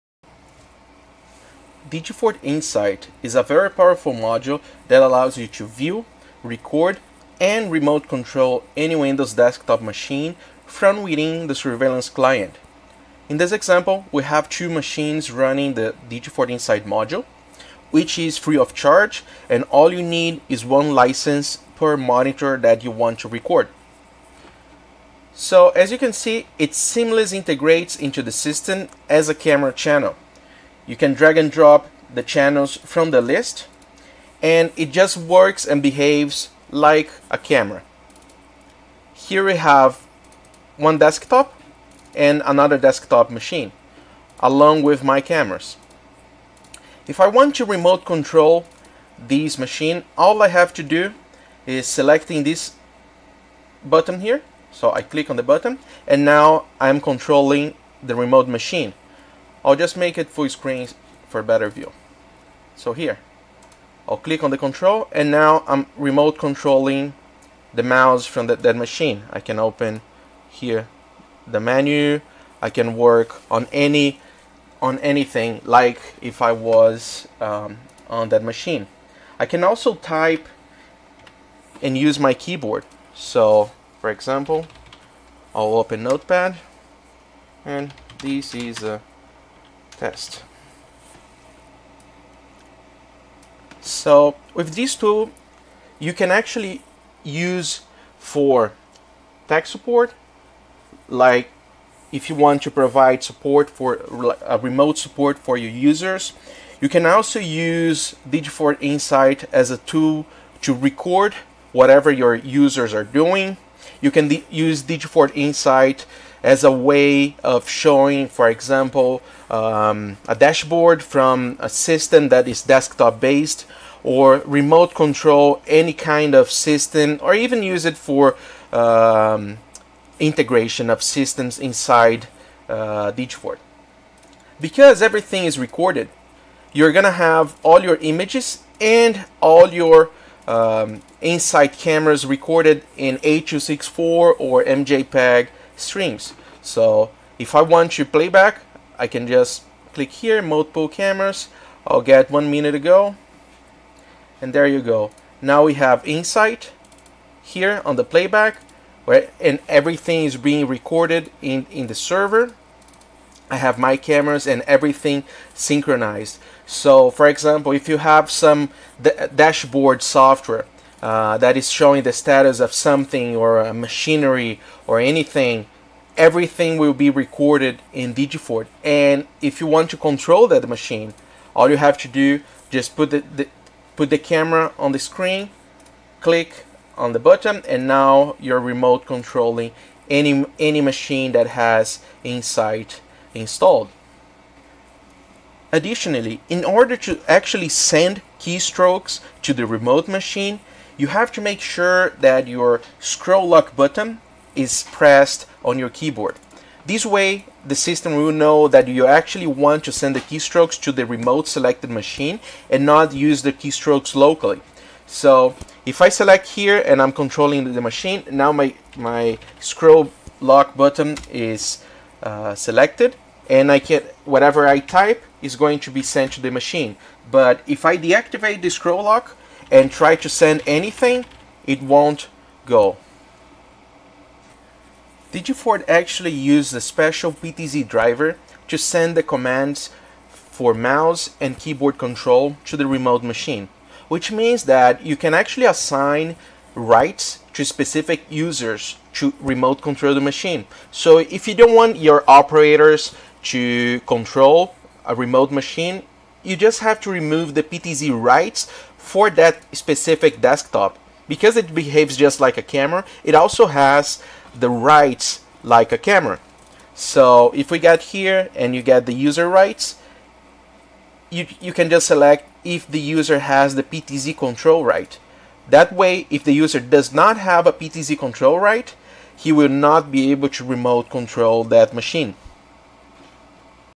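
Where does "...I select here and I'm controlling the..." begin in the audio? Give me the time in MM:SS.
03:36.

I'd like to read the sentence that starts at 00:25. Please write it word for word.
So as you can see, it seamlessly integrates into the system as a camera channel.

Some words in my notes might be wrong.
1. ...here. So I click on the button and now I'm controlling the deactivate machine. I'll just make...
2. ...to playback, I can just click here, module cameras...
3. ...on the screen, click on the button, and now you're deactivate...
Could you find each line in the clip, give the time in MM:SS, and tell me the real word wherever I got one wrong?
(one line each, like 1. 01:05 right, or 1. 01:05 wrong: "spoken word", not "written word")
1. 00:54 wrong: "remote", not "deactivate"
2. 02:27 wrong: "multiple", not "module"
3. 03:04 wrong: "remote", not "deactivate".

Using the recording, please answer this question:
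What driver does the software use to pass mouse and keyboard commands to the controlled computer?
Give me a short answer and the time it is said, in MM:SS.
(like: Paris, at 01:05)
PTZ driver, at 03:57.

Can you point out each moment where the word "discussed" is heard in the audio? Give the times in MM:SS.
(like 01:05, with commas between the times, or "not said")
not said.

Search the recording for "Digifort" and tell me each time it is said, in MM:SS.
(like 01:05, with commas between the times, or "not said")
00:01, 00:16, 01:48, 01:54, 02:58, 03:55.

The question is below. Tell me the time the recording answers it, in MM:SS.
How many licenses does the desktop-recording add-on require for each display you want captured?
00:20.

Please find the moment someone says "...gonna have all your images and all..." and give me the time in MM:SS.
02:16.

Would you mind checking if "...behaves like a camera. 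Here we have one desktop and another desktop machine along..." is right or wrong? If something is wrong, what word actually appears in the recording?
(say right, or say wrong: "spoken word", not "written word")
right.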